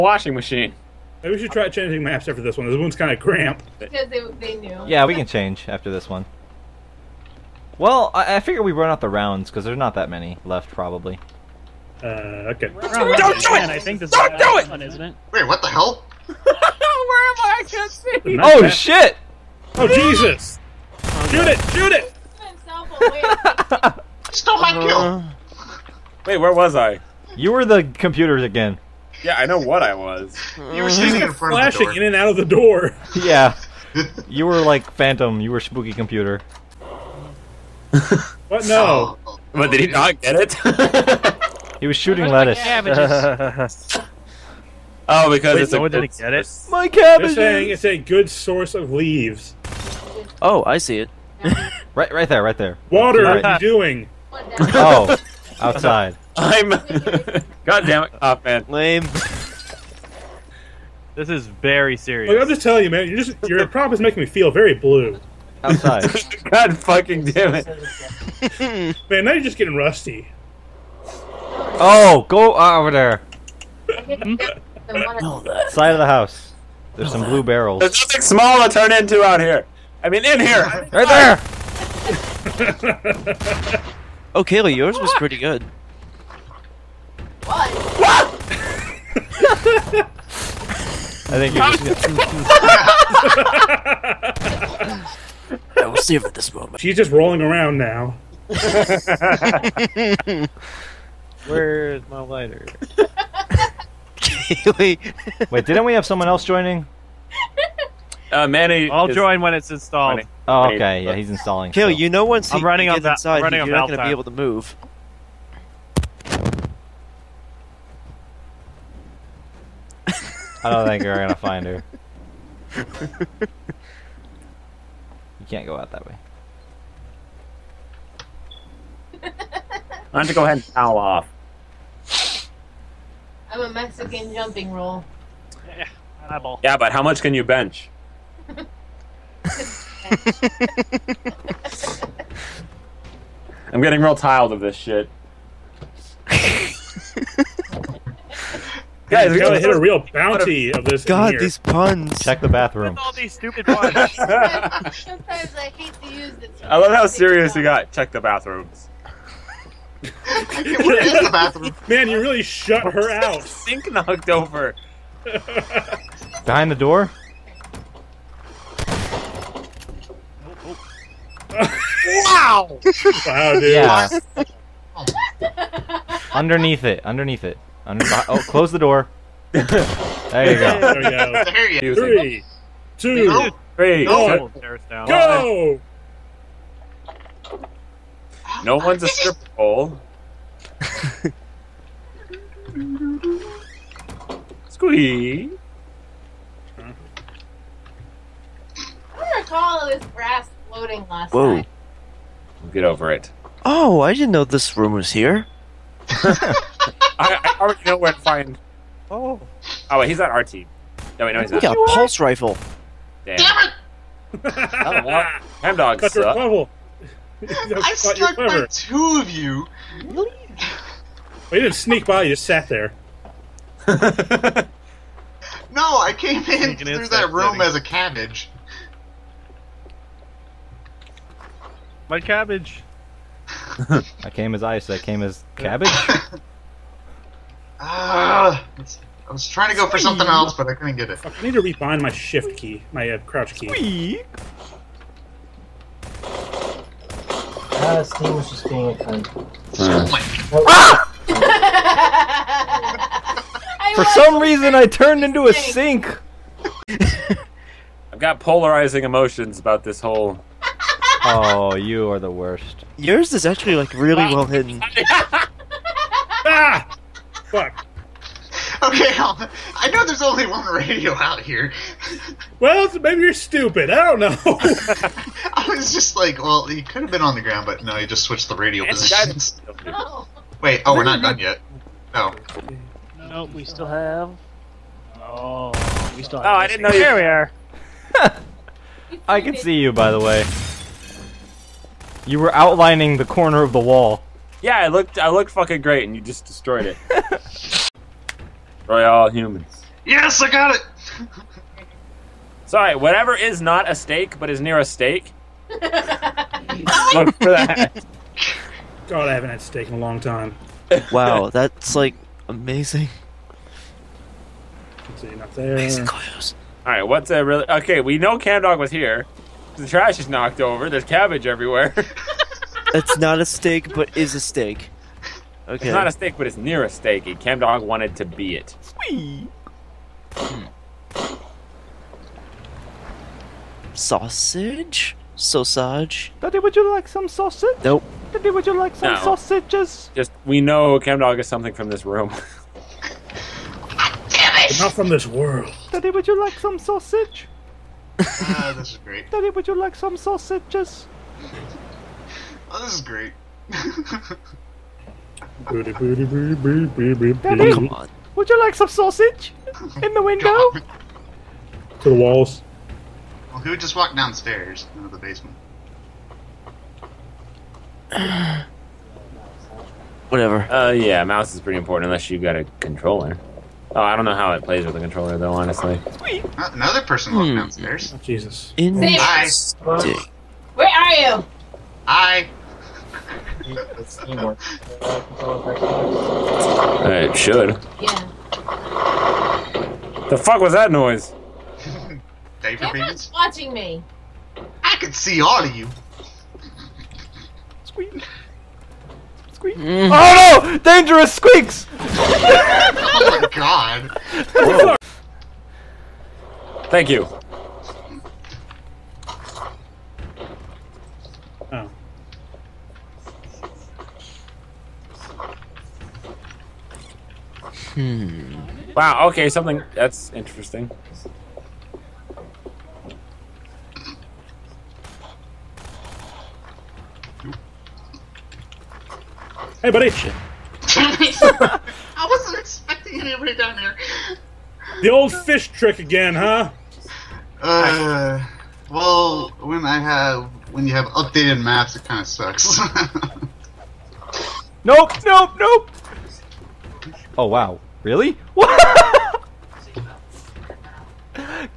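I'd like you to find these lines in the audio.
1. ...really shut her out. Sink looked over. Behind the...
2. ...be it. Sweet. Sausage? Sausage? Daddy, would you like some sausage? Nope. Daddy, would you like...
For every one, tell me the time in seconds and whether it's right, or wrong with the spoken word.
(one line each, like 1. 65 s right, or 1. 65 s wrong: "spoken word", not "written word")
1. 162 s wrong: "knocked", not "looked"
2. 328 s right.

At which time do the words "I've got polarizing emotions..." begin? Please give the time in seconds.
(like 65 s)
258 s.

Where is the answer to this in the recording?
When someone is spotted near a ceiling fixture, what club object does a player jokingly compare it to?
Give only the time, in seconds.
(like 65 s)
189 s.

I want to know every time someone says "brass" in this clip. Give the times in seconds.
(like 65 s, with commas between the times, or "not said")
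200 s.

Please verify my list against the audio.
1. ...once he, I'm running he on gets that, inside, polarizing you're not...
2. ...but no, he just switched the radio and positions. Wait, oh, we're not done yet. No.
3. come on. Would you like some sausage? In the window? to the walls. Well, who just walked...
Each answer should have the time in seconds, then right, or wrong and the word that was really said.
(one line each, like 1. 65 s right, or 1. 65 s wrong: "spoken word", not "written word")
1. 112 s wrong: "running", not "polarizing"
2. 277 s right
3. 357 s right.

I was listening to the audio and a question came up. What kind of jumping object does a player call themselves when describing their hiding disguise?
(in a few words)
Mexican jumping roll.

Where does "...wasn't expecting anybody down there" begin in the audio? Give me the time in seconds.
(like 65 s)
432 s.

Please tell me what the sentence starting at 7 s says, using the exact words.
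Well, I, I figure we run out the rounds because there's not that many left, probably.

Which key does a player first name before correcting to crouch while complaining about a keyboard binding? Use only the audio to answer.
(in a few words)
shift key.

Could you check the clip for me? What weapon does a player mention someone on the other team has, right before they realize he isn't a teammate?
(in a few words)
pulse rifle.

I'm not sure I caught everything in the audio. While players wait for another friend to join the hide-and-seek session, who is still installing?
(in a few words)
Manny.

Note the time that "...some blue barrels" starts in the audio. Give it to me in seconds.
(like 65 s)
77 s.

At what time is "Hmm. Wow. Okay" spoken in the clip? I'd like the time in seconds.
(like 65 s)
418 s.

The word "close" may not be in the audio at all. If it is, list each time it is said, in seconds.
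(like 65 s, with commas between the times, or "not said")
178 s, 316 s.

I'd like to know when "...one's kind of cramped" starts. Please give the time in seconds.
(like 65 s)
2 s.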